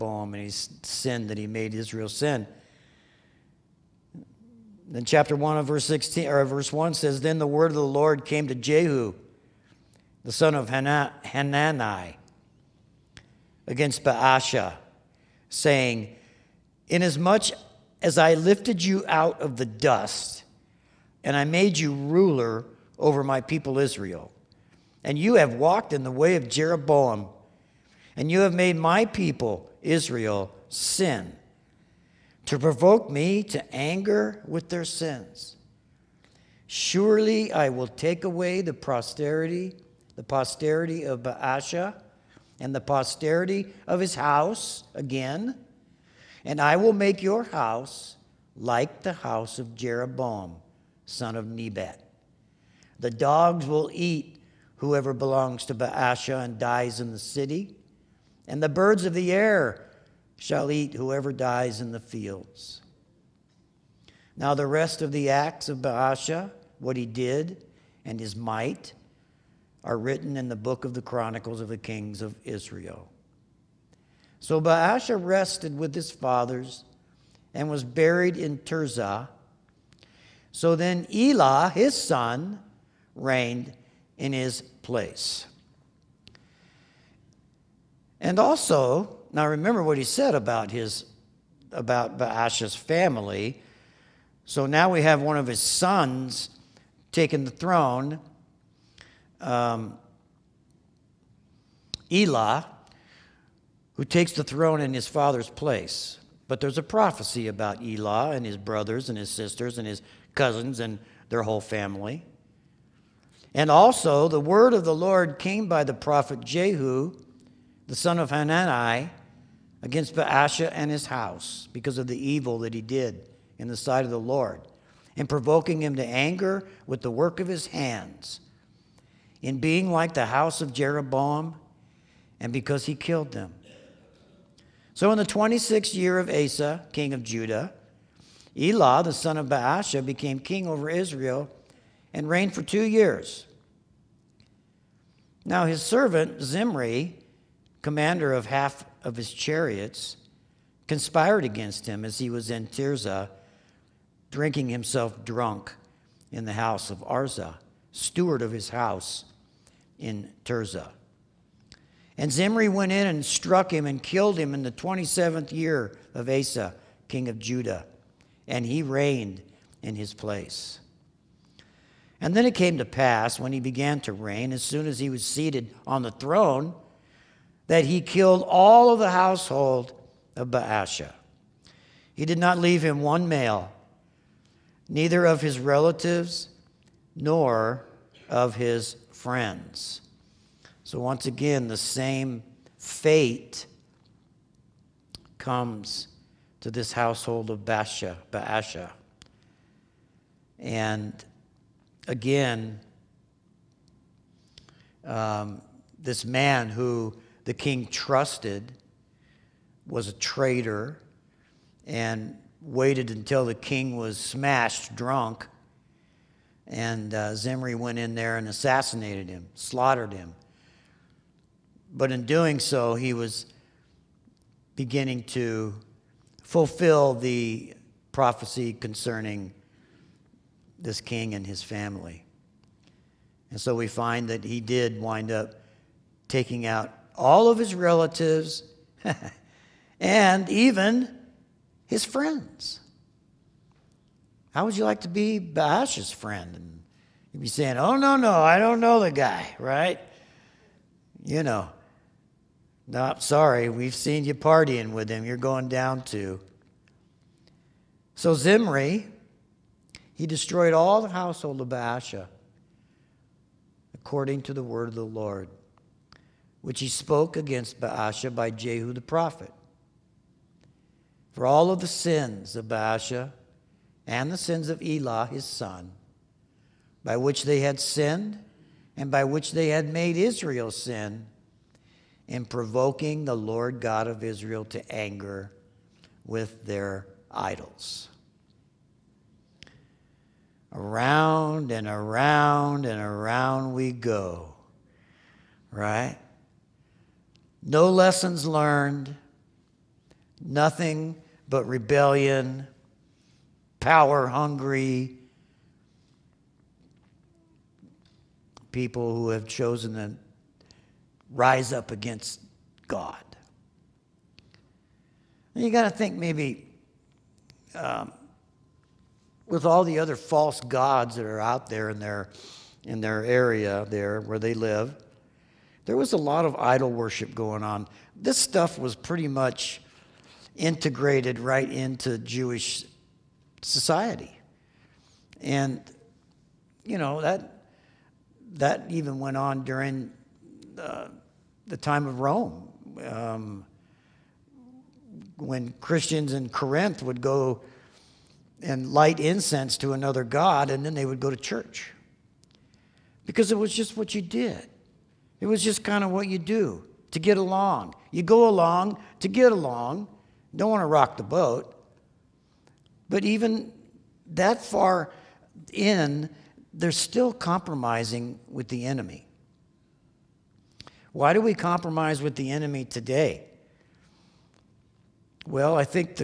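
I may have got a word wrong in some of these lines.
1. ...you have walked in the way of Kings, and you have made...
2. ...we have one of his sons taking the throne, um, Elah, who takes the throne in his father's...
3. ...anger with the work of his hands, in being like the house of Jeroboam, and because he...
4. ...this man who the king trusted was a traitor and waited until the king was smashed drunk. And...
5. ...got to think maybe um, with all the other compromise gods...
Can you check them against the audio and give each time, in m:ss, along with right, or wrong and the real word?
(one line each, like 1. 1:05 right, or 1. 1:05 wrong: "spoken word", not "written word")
1. 0:25 wrong: "Jeroboam", not "Kings"
2. 1:34 right
3. 2:06 right
4. 3:25 right
5. 5:15 wrong: "false", not "compromise".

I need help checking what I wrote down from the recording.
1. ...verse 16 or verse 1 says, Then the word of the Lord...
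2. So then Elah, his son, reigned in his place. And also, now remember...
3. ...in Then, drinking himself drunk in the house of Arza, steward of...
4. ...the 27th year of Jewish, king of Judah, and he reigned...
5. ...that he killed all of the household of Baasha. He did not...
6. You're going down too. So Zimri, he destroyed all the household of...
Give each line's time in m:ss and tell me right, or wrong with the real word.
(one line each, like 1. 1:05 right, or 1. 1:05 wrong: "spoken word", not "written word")
1. 0:05 right
2. 1:20 right
3. 2:32 wrong: "Tirzah", not "Then"
4. 2:44 wrong: "Asa", not "Jewish"
5. 2:57 right
6. 4:15 right.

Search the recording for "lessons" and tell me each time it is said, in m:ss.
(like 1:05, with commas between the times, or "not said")
4:57.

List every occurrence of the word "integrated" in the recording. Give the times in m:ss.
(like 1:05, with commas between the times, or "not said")
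5:30.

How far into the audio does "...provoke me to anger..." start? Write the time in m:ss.
0:32.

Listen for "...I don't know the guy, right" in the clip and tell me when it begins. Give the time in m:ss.
4:08.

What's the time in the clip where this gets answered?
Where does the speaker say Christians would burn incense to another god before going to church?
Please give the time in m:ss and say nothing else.
5:46.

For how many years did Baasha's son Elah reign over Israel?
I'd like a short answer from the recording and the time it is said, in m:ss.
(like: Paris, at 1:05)
2, at 2:22.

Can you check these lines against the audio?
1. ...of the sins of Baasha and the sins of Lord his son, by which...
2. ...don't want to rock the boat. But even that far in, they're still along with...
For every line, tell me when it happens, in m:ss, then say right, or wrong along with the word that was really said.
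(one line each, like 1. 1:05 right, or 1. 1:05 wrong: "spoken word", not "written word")
1. 4:31 wrong: "Elah", not "Lord"
2. 6:00 wrong: "compromising", not "along".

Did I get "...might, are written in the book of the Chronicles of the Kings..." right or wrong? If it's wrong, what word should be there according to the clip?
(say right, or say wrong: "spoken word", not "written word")
right.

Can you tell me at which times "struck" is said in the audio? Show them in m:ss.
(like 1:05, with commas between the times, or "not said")
2:43.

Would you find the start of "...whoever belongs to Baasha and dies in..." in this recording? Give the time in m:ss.
0:54.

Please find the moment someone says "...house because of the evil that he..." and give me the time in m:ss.
2:01.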